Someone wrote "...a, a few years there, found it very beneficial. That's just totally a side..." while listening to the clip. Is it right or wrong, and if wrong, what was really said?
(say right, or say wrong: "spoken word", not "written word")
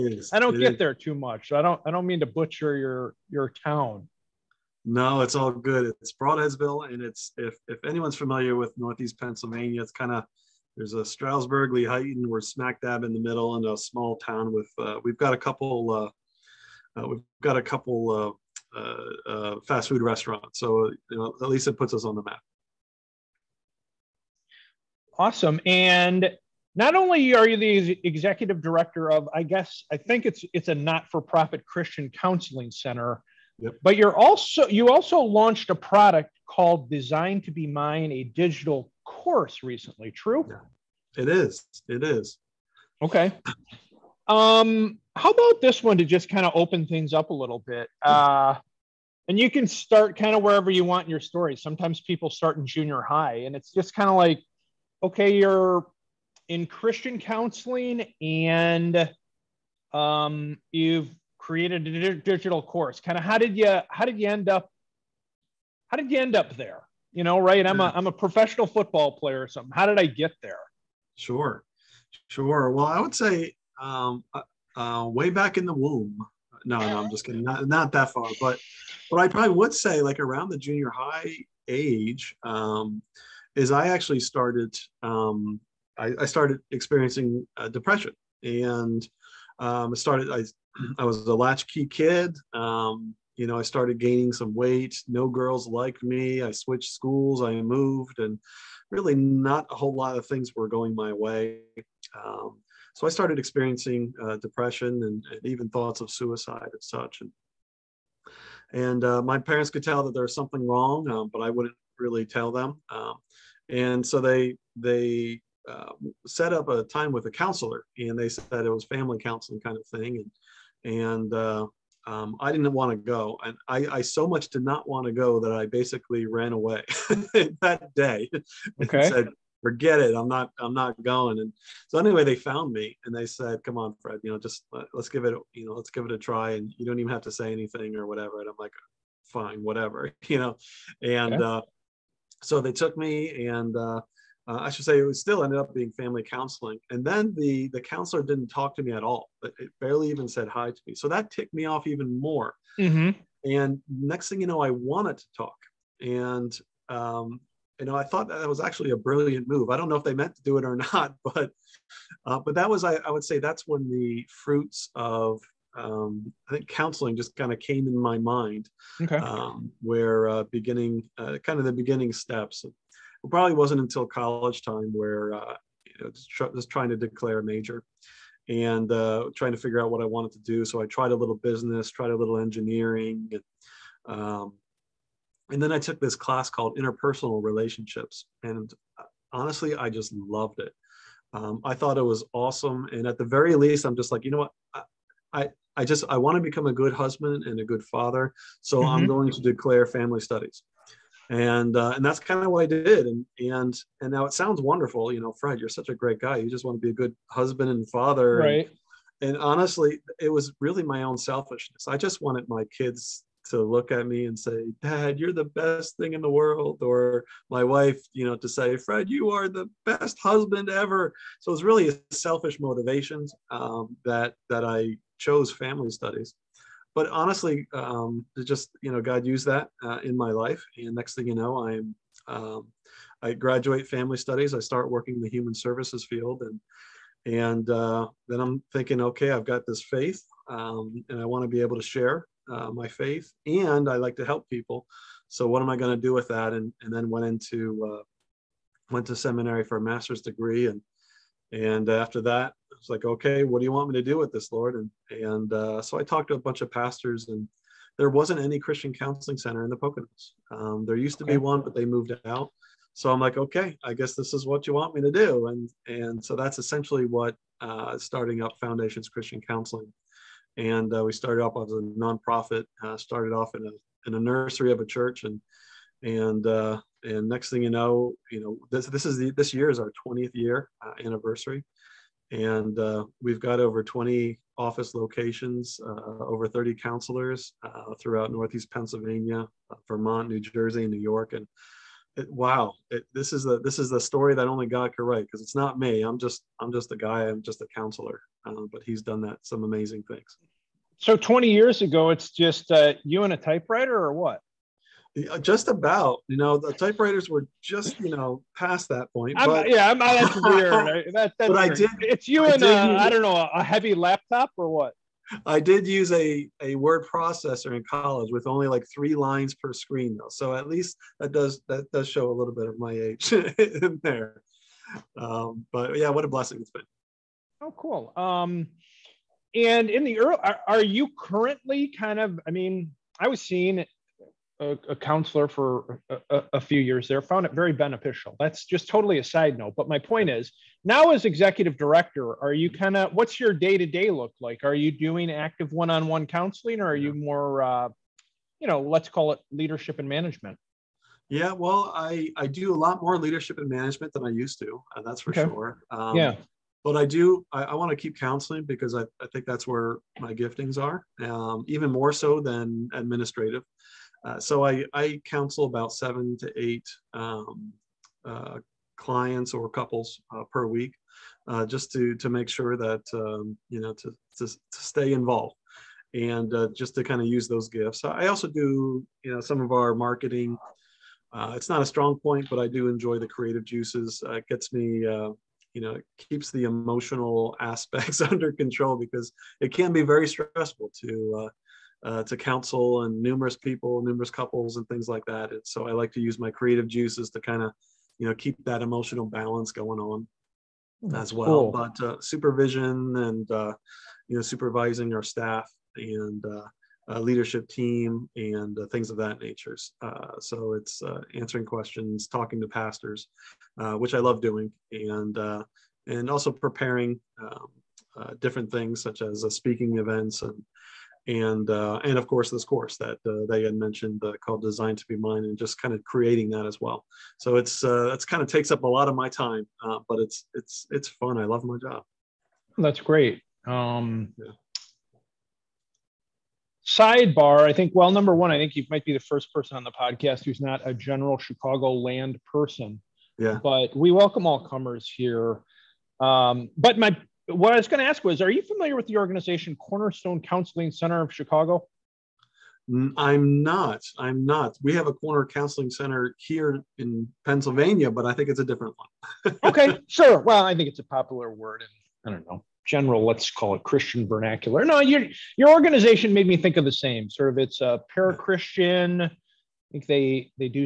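right.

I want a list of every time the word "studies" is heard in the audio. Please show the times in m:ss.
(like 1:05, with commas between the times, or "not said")
3:20, 3:45, 3:54.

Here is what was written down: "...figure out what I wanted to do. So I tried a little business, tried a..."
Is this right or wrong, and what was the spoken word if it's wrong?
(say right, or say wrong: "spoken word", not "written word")
right.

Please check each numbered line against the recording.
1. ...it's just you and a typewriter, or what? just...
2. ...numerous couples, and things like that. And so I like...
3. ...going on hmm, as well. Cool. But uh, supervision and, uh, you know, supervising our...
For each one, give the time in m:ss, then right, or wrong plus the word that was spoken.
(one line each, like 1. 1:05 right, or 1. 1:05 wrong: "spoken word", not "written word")
1. 5:02 right
2. 6:34 right
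3. 6:39 right.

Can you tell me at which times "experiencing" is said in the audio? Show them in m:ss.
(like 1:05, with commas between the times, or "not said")
1:26, 1:43.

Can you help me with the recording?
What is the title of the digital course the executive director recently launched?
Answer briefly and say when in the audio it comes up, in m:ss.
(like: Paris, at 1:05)
Design to Be Mine, at 0:36.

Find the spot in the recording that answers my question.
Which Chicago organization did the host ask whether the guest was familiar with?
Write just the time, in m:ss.
7:29.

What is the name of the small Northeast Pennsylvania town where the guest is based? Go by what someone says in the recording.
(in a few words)
Brodheadsville.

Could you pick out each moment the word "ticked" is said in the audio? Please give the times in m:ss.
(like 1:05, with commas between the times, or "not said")
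2:31.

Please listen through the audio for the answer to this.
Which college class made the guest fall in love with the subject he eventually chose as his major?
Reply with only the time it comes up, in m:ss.
3:06.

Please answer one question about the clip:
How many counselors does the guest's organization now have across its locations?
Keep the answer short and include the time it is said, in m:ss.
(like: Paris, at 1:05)
Over 30, at 4:46.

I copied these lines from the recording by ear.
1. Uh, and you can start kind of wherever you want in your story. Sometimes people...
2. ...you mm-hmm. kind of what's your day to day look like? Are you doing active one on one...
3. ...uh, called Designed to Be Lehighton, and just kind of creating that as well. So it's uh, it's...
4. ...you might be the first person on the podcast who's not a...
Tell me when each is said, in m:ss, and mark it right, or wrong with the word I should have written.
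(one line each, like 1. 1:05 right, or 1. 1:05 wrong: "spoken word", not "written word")
1. 0:48 right
2. 5:42 right
3. 7:04 wrong: "Mine", not "Lehighton"
4. 7:18 right.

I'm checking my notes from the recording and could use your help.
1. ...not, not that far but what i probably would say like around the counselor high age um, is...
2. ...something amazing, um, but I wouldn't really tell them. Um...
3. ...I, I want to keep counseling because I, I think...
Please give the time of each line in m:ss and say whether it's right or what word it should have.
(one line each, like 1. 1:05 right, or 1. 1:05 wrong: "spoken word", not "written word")
1. 1:17 wrong: "junior", not "counselor"
2. 1:50 wrong: "wrong", not "amazing"
3. 5:57 right.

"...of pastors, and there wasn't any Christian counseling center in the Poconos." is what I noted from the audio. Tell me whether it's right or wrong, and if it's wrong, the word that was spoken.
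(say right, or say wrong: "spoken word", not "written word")
right.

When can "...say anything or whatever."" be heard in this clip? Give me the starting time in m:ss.
2:17.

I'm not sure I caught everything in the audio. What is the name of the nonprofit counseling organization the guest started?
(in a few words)
Foundations Christian Counseling.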